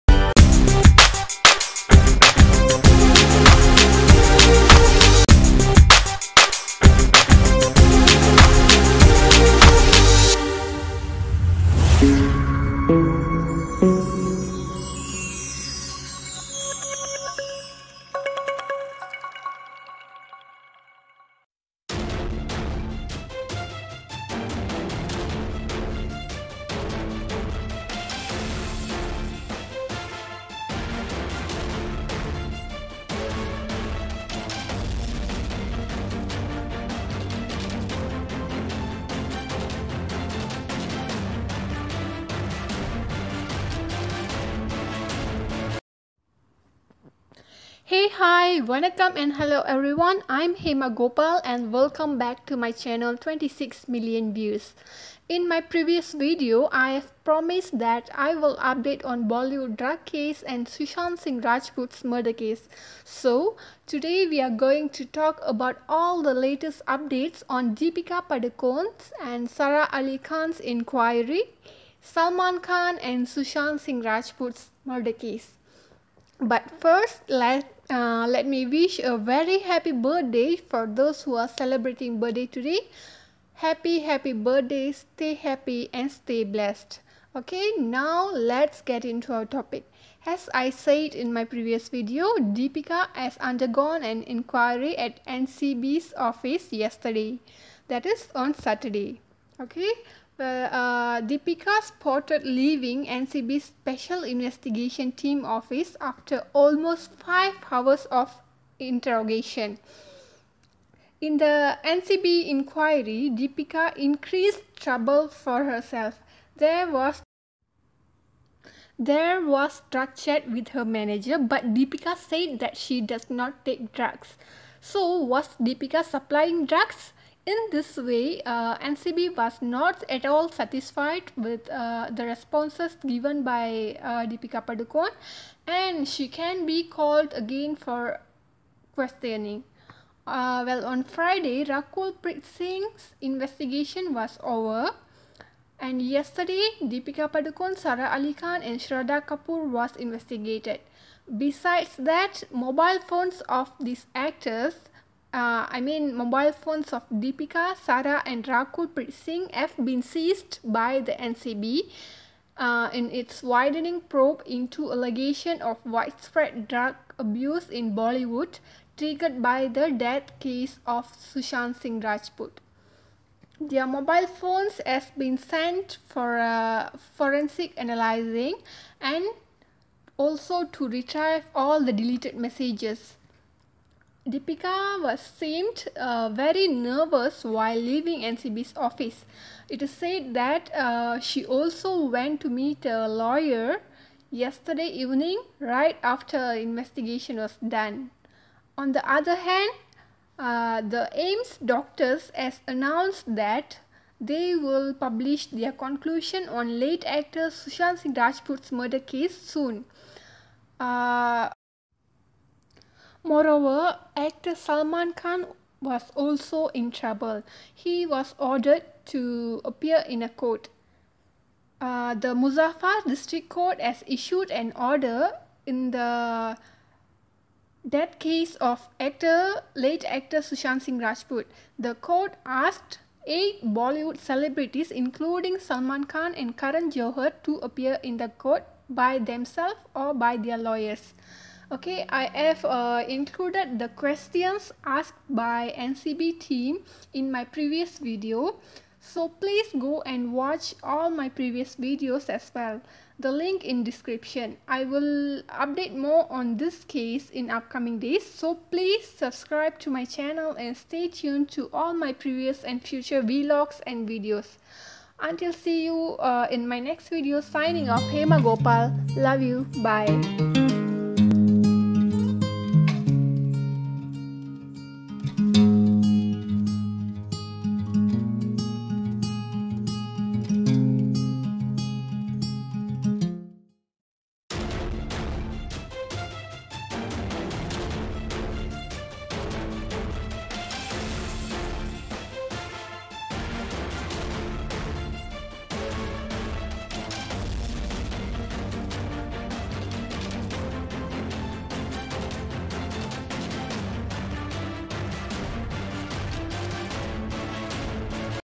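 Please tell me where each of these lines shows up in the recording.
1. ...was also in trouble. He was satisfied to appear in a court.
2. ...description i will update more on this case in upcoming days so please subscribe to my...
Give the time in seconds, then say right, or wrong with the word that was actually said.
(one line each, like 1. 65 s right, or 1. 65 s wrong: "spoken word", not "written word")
1. 215 s wrong: "ordered", not "satisfied"
2. 253 s right.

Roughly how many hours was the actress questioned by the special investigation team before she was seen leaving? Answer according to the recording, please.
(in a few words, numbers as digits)
5 hours.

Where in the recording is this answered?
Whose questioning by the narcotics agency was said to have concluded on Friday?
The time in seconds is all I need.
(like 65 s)
141 s.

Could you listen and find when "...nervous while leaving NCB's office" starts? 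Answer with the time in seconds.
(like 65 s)
186 s.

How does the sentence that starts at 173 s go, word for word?
Their mobile phones has been sent for uh, forensic analyzing and also to retrieve all the deleted messages.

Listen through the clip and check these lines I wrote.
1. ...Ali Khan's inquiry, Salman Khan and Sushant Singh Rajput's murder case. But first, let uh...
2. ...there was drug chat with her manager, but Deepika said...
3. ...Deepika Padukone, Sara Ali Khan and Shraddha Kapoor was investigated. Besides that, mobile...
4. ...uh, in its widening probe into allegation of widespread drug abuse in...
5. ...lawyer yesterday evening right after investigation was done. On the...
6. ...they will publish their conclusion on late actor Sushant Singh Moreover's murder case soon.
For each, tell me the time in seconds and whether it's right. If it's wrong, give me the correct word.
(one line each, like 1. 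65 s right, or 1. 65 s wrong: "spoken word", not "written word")
1. 69 s right
2. 118 s right
3. 146 s right
4. 162 s right
5. 193 s right
6. 204 s wrong: "Rajput", not "Moreover".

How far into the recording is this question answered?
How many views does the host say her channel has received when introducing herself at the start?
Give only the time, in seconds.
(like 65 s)
53 s.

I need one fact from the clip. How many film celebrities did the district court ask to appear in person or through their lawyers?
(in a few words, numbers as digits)
8.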